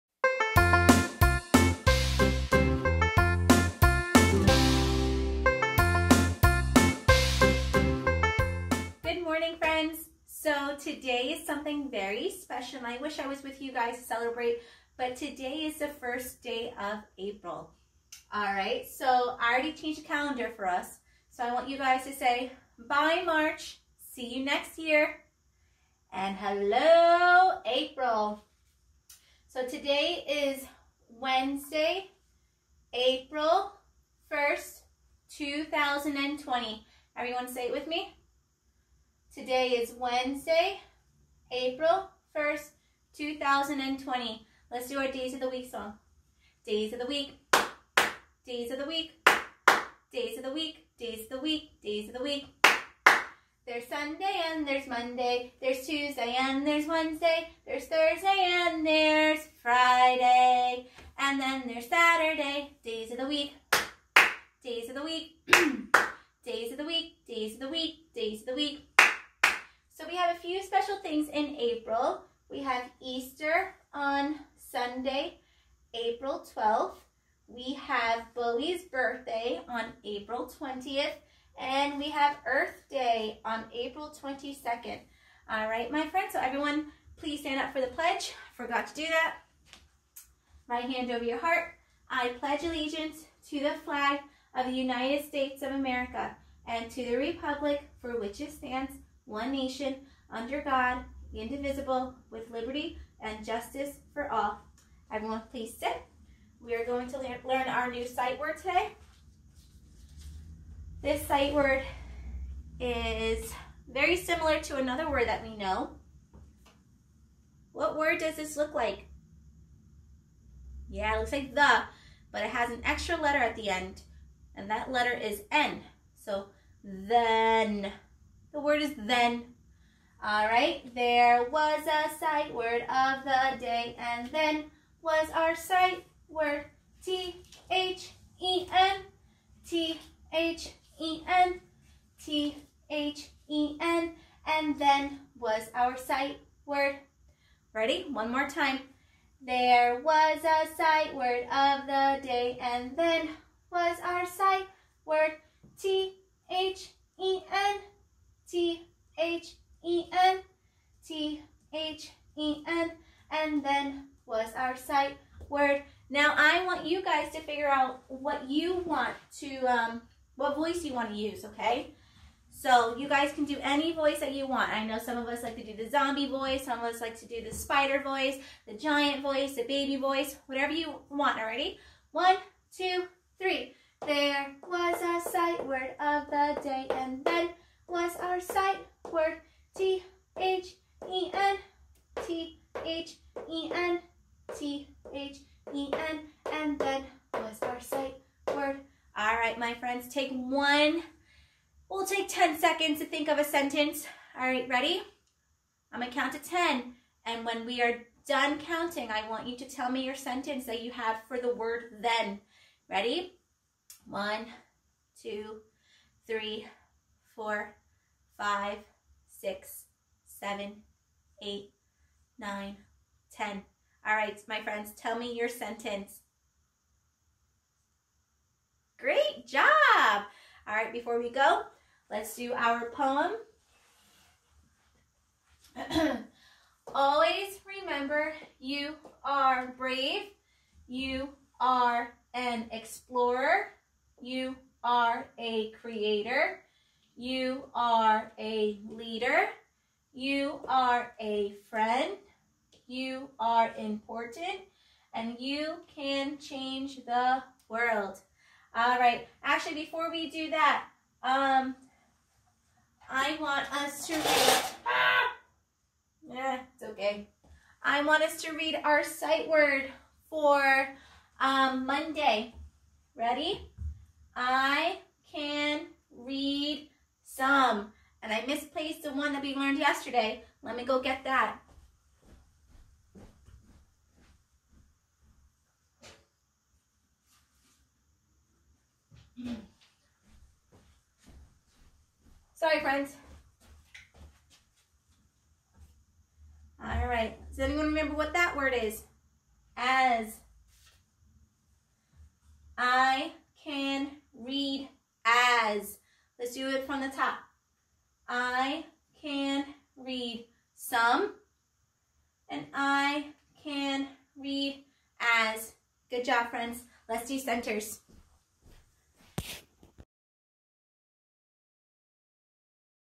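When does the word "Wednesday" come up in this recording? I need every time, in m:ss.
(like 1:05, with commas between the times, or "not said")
0:31, 0:39, 0:56.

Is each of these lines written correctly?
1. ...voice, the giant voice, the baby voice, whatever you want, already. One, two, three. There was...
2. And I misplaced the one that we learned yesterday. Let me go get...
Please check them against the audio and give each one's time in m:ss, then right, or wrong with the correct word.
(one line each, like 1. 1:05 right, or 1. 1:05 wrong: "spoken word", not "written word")
1. 2:58 right
2. 4:38 right.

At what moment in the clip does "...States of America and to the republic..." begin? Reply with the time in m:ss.
1:35.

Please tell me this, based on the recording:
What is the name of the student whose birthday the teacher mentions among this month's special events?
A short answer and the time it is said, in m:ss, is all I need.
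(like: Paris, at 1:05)
Billy, at 1:18.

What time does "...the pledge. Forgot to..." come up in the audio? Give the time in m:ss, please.
1:27.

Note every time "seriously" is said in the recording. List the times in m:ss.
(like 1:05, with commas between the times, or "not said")
not said.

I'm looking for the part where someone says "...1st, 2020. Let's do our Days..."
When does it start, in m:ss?
0:42.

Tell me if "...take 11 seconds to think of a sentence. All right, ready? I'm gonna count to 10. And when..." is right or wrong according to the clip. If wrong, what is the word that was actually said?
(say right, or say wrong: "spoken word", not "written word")
wrong: "10", not "11".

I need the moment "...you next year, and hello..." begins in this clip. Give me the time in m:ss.
0:24.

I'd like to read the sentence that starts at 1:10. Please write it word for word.
So we have a few special things in April.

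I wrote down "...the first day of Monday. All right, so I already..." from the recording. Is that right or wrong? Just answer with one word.
wrong.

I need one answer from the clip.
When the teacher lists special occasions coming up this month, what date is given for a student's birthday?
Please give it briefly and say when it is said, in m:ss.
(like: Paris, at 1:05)
April 20th, at 1:20.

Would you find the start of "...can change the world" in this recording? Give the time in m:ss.
4:15.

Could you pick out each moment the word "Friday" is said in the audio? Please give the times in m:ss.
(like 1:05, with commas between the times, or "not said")
0:59.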